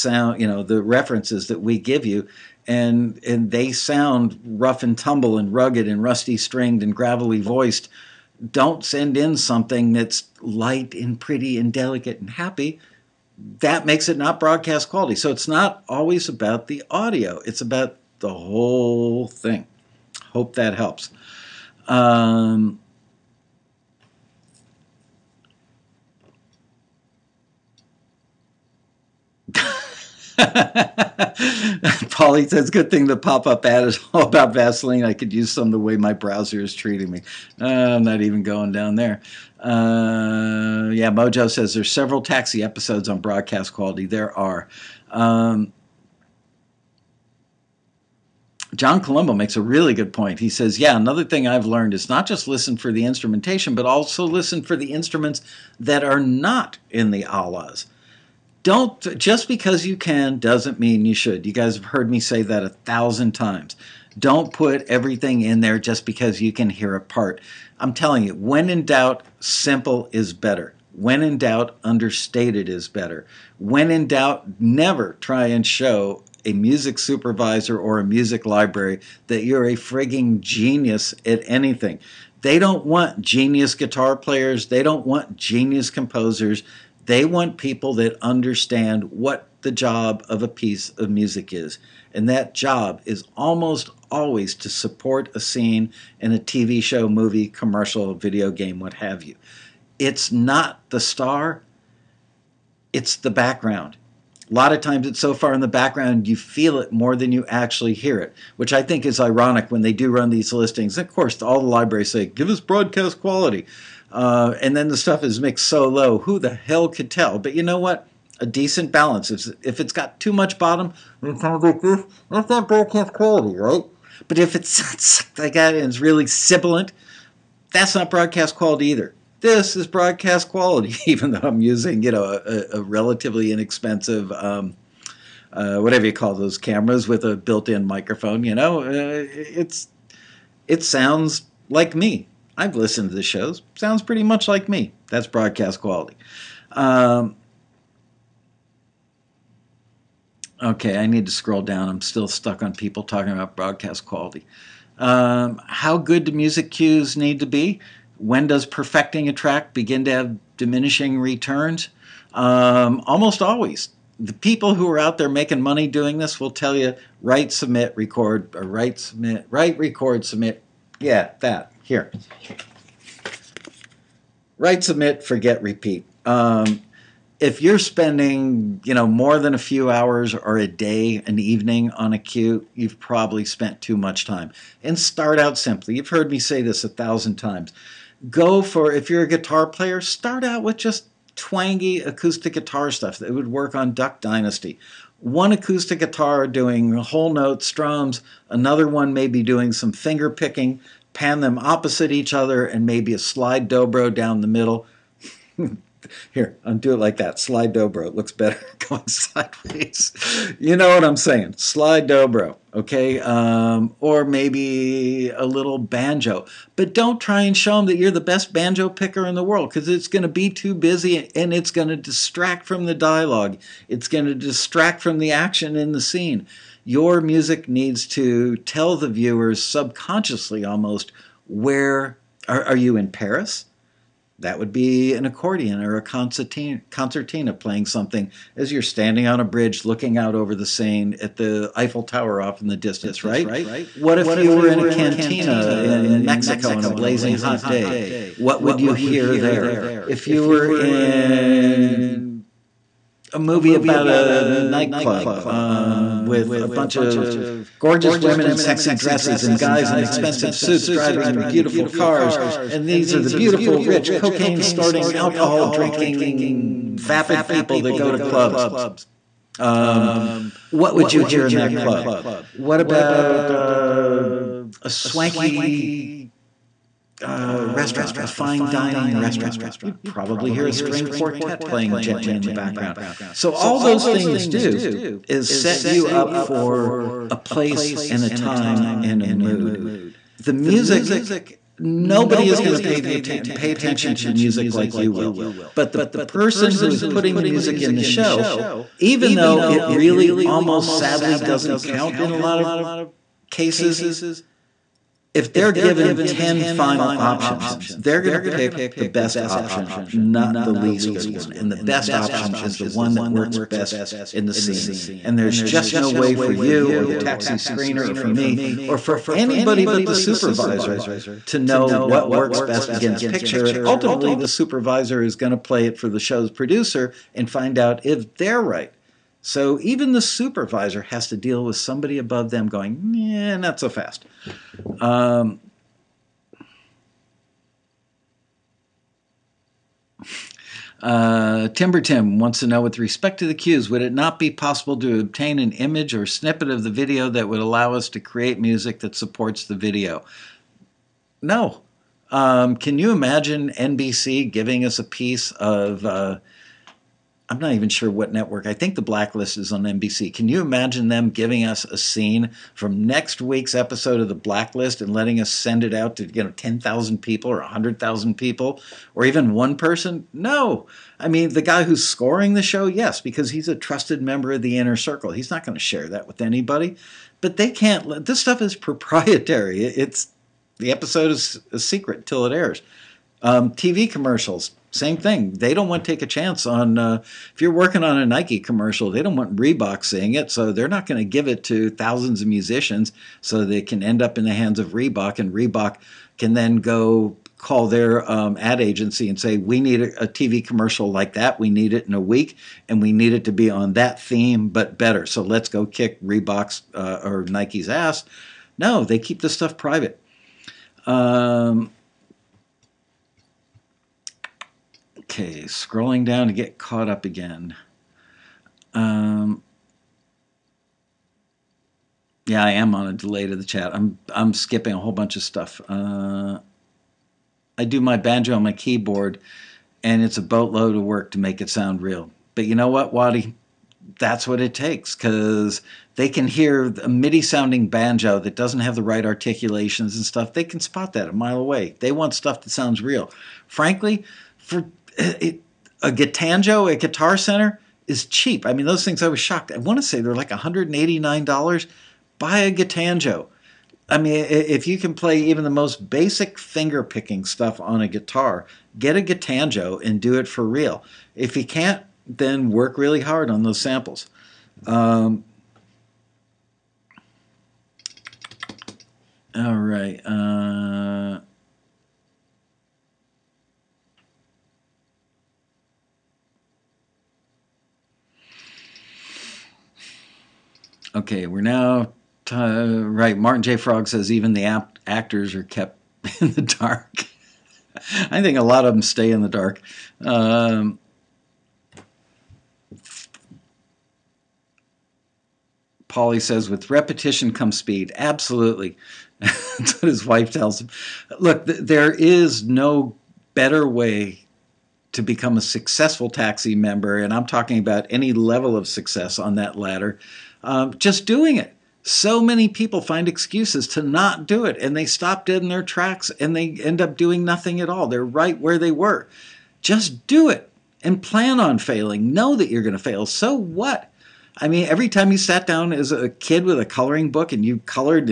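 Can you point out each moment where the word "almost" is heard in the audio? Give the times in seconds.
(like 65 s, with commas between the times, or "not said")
93 s, 163 s, 230 s, 300 s.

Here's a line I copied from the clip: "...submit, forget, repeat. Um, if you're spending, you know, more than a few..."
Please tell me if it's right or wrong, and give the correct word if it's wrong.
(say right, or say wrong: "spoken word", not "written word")
right.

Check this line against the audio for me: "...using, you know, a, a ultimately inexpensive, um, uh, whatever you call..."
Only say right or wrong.
wrong.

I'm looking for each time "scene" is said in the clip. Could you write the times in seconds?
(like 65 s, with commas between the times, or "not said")
95 s, 226 s, 314 s, 361 s.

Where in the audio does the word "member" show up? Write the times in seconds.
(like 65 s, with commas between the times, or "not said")
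374 s, 506 s.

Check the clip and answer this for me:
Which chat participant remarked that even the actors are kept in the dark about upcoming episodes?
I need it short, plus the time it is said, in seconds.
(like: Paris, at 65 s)
Martin J. Frog, at 483 s.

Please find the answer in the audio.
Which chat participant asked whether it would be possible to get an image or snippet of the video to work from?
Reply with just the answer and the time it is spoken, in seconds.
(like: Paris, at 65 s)
Timber Tim, at 341 s.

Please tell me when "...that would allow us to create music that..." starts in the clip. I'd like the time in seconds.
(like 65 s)
347 s.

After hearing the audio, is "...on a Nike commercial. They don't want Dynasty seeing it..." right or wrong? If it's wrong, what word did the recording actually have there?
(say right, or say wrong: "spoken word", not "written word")
wrong: "Reebok", not "Dynasty".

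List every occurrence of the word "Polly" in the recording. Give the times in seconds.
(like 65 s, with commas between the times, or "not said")
32 s, 496 s.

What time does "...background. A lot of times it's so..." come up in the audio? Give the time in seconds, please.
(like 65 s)
103 s.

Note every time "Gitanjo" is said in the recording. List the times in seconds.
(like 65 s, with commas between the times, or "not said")
446 s, 452 s, 459 s.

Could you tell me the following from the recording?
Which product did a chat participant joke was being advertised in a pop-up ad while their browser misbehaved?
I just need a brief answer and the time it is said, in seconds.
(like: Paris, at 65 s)
Vaseline, at 34 s.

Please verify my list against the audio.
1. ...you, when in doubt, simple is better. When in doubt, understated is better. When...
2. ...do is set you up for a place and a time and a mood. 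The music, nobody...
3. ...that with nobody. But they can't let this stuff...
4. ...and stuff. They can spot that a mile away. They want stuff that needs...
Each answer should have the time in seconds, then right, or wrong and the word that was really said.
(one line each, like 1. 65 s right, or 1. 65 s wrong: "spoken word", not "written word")
1. 68 s right
2. 284 s right
3. 376 s wrong: "anybody", not "nobody"
4. 440 s wrong: "sounds", not "needs".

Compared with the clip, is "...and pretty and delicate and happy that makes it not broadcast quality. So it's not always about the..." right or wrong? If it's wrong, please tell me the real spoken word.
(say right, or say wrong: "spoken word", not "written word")
right.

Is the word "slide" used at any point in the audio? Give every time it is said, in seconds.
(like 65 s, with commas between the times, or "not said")
203 s, 207 s, 211 s.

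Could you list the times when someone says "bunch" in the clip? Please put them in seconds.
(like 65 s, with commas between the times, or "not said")
256 s, 425 s.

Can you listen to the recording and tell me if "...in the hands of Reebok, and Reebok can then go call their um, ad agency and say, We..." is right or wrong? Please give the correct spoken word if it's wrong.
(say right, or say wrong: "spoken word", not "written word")
right.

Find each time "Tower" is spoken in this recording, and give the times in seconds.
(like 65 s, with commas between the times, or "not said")
242 s.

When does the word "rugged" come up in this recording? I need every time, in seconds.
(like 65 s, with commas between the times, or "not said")
5 s.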